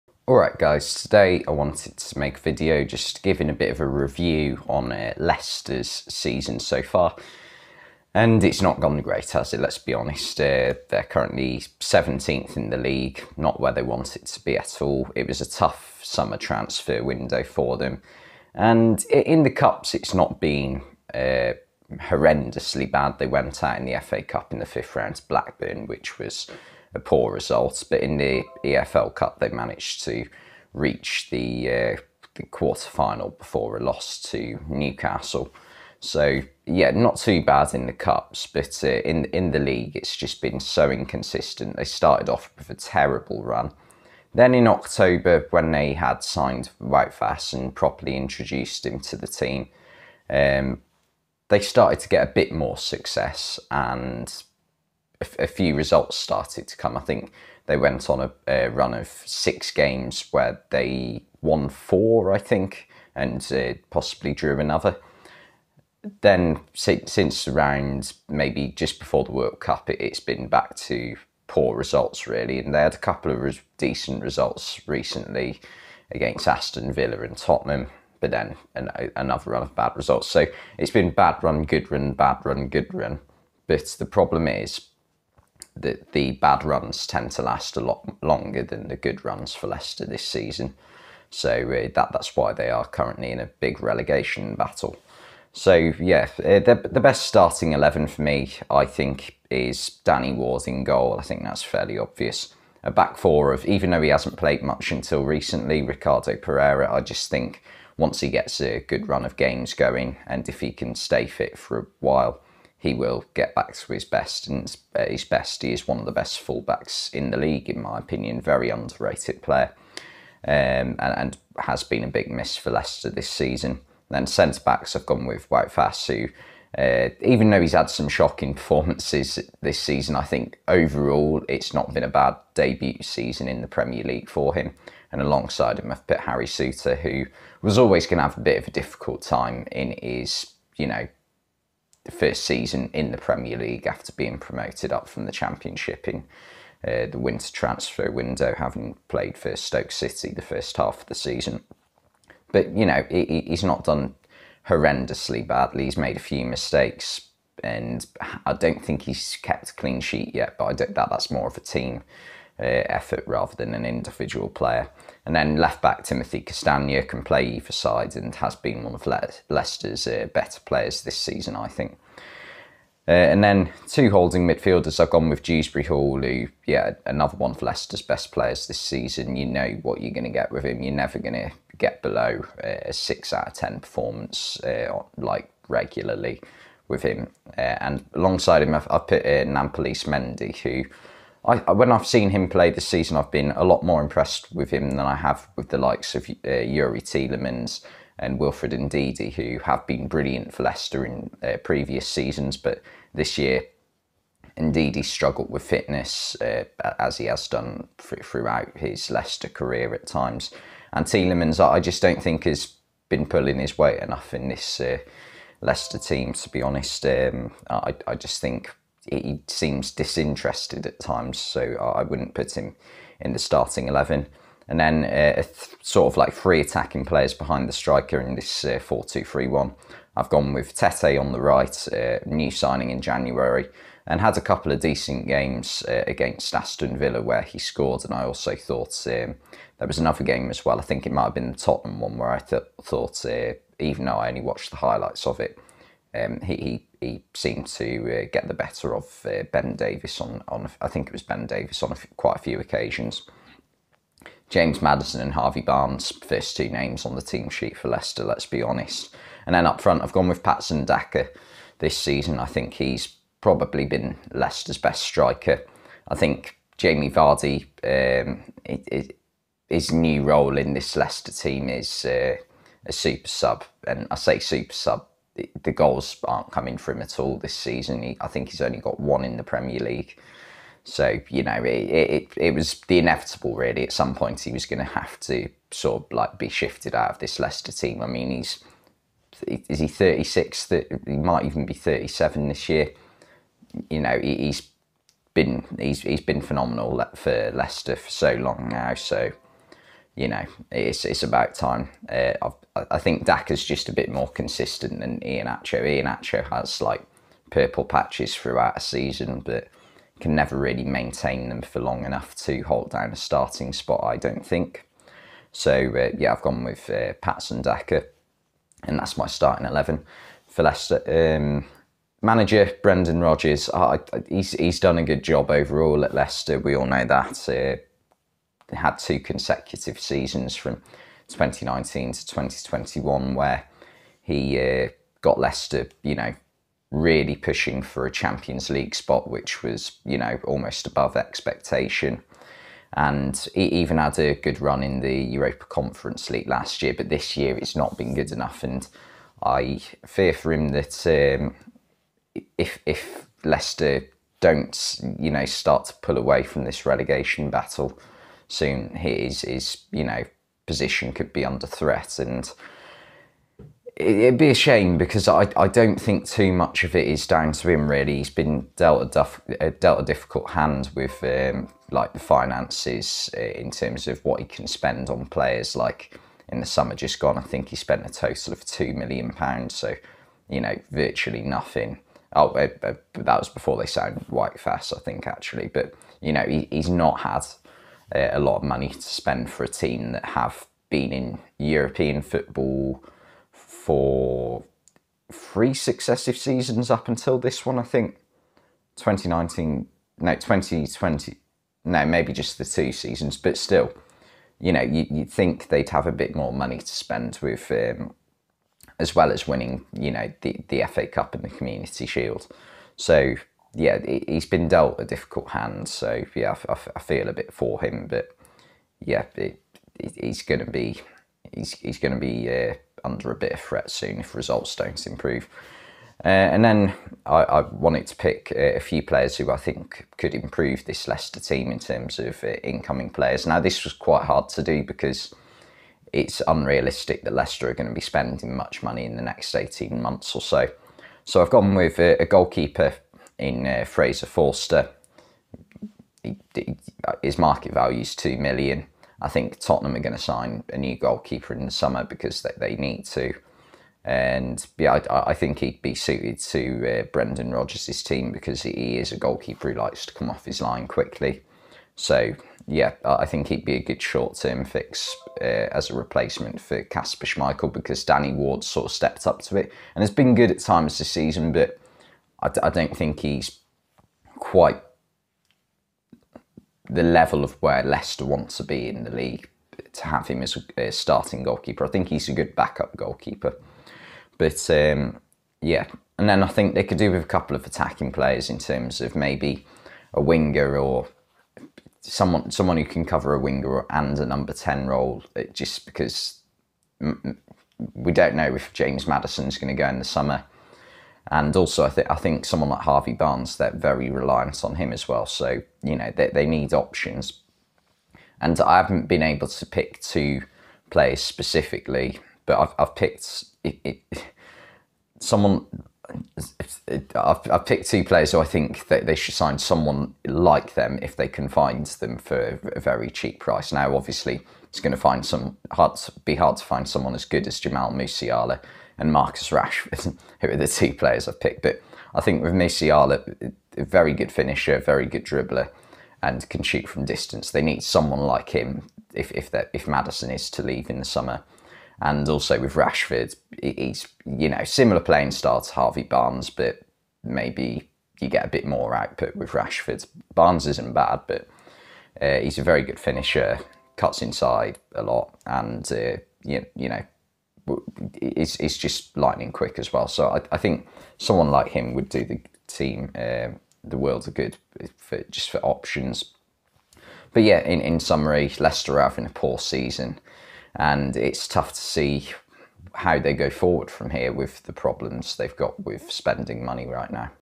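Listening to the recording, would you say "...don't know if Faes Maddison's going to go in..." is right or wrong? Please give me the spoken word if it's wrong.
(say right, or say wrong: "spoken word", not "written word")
wrong: "James", not "Faes".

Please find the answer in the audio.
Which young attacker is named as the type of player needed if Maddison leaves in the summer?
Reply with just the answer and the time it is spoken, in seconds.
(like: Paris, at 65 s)
Jamal Musiala, at 527 s.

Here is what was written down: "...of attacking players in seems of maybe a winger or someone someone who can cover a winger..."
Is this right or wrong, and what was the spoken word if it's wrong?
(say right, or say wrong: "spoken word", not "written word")
wrong: "terms", not "seems".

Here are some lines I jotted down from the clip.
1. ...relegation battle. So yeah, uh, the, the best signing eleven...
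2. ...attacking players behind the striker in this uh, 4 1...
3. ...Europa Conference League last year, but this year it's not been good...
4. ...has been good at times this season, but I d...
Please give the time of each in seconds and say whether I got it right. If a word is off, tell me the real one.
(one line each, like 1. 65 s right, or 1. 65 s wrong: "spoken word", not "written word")
1. 93 s wrong: "starting", not "signing"
2. 226 s wrong: "2", not "1"
3. 345 s right
4. 470 s right.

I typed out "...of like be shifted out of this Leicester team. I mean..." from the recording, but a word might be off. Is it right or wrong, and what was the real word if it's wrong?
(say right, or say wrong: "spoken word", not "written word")
right.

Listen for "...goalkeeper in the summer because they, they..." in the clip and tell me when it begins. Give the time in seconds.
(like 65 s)
450 s.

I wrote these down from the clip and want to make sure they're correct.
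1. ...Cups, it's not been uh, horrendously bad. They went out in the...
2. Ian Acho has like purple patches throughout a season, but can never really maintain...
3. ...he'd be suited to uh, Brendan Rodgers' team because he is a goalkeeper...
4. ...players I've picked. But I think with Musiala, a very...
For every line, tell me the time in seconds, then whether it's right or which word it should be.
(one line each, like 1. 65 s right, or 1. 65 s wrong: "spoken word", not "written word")
1. 19 s right
2. 305 s right
3. 455 s right
4. 530 s right.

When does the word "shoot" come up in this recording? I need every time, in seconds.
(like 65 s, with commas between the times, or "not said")
536 s.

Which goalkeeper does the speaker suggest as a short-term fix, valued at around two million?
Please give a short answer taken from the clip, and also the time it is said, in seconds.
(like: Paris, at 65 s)
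Fraser Forster, at 443 s.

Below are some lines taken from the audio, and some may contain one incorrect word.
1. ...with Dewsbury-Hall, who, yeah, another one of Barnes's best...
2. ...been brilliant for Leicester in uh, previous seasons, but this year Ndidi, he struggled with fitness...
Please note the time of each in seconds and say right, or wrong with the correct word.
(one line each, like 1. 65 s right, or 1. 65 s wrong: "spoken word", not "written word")
1. 175 s wrong: "Leicester", not "Barnes"
2. 199 s right.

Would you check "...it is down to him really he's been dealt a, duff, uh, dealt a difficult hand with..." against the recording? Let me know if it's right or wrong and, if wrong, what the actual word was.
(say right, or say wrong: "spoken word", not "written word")
right.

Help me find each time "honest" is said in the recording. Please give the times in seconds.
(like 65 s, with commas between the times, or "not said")
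9 s, 216 s, 258 s.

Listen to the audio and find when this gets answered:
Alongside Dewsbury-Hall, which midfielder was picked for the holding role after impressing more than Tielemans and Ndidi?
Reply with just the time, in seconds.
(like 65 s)
189 s.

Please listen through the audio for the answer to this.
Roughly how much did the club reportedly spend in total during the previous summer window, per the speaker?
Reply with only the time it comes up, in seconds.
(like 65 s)
378 s.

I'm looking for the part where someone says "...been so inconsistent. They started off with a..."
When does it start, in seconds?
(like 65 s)
40 s.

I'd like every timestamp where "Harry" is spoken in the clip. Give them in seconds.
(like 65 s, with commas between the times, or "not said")
136 s.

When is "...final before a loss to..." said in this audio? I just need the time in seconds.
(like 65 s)
32 s.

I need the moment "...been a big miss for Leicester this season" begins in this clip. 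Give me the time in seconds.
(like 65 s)
121 s.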